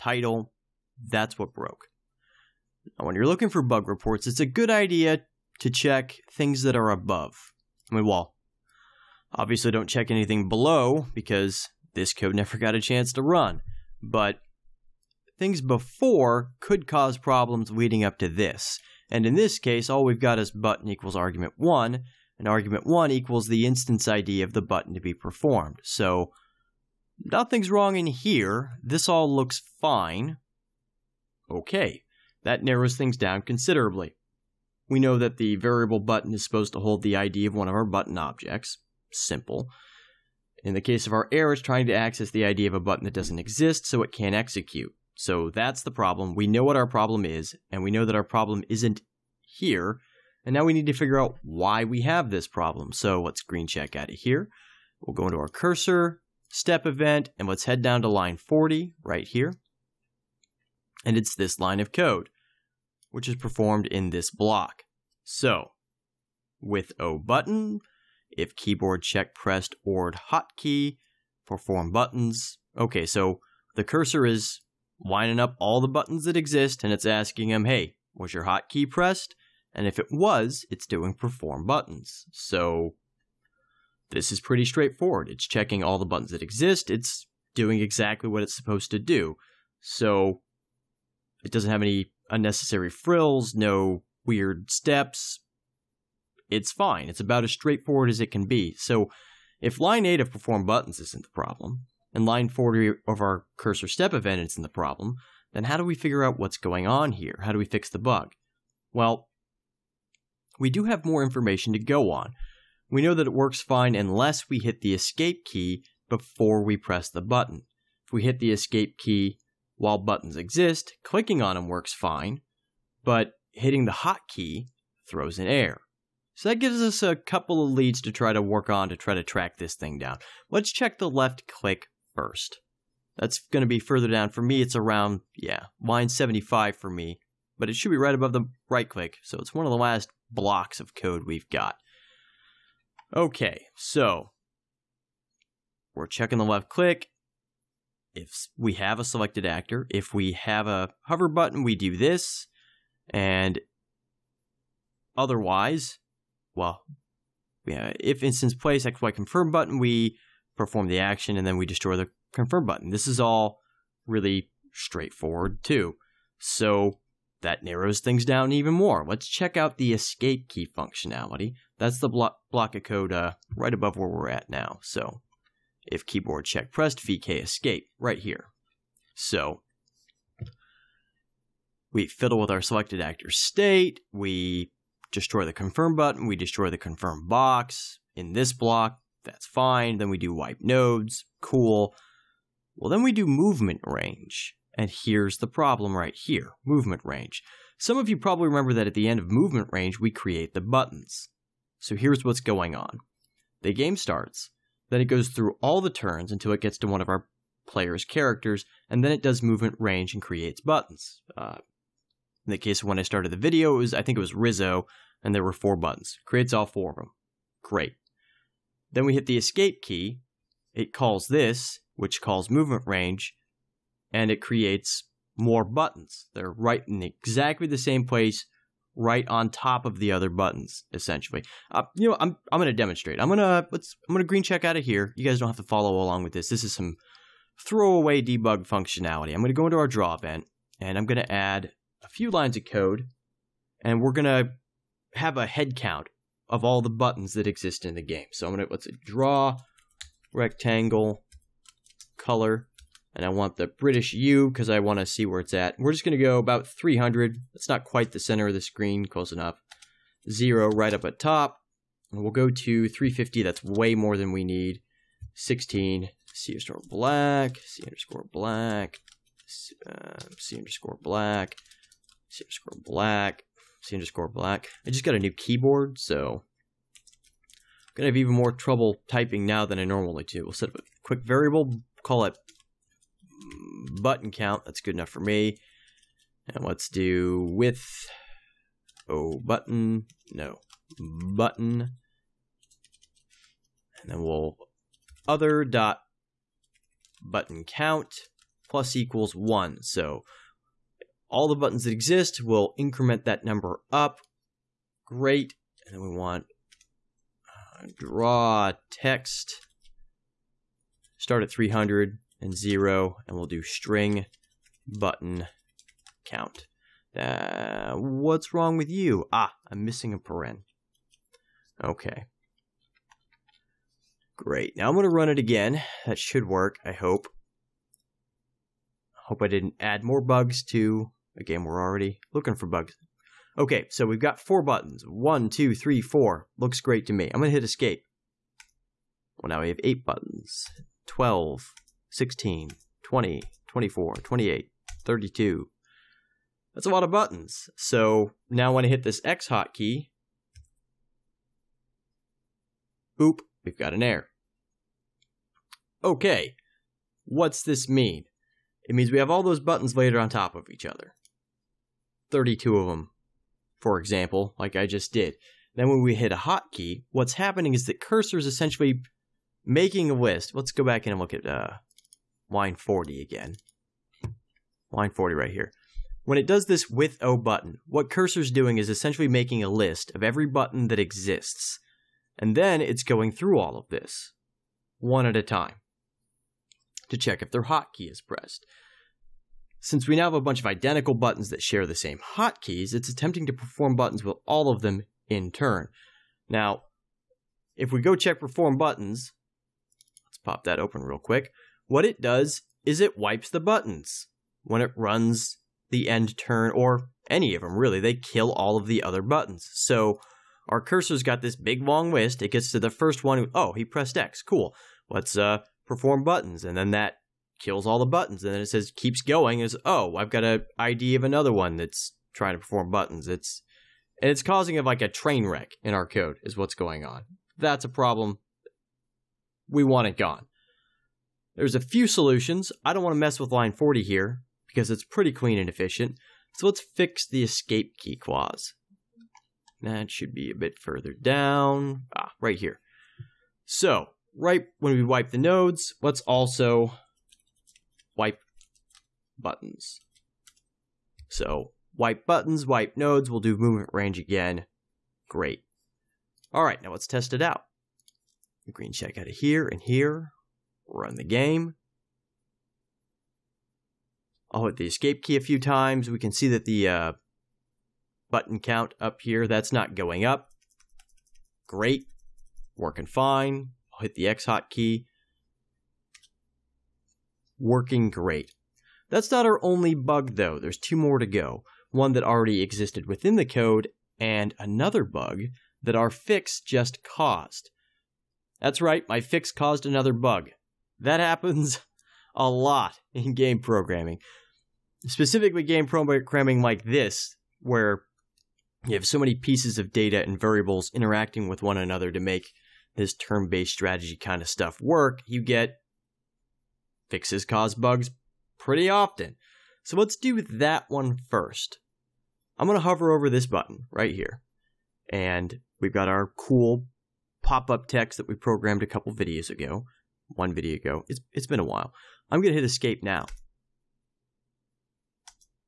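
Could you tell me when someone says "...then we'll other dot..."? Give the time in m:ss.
4:54.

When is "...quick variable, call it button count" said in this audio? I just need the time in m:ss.
4:41.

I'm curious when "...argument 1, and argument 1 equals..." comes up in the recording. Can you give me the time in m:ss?
0:21.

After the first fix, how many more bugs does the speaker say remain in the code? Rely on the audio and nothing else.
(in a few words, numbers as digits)
2.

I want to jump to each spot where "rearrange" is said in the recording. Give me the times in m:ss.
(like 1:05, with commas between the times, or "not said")
not said.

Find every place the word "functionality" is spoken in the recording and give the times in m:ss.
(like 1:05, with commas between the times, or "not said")
2:50, 3:58.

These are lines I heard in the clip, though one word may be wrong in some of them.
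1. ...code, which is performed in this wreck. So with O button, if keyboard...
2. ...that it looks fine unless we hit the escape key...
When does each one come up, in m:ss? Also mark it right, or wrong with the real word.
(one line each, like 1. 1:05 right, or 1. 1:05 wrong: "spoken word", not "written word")
1. 1:01 wrong: "block", not "wreck"
2. 1:53 wrong: "works", not "looks".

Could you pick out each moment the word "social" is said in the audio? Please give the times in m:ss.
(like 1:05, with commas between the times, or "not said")
not said.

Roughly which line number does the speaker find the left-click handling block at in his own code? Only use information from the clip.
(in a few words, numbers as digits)
75.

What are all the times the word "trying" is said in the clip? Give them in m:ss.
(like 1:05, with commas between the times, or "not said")
0:41, 7:02.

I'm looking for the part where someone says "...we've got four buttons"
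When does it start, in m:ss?
5:34.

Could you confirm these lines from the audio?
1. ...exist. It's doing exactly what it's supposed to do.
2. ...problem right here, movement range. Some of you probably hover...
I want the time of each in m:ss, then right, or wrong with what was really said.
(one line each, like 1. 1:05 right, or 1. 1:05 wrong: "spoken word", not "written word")
1. 1:26 right
2. 3:15 wrong: "remember", not "hover".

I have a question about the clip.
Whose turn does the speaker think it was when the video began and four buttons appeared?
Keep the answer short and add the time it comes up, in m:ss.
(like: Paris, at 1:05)
Rizzo, at 3:34.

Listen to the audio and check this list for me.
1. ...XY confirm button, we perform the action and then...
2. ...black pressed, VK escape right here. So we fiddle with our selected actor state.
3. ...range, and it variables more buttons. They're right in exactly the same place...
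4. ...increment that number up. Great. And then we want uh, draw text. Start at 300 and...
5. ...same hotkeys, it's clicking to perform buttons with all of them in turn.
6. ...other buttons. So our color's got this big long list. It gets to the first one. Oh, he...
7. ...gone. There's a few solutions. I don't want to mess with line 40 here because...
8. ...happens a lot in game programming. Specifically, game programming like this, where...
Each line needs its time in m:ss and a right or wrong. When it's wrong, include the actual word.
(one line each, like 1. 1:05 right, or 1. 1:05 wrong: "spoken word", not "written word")
1. 2:38 right
2. 2:56 wrong: "check", not "black"
3. 3:42 wrong: "creates", not "variables"
4. 5:02 right
5. 6:31 wrong: "attempting", not "clicking"
6. 6:49 wrong: "cursor", not "color"
7. 7:10 right
8. 8:11 right.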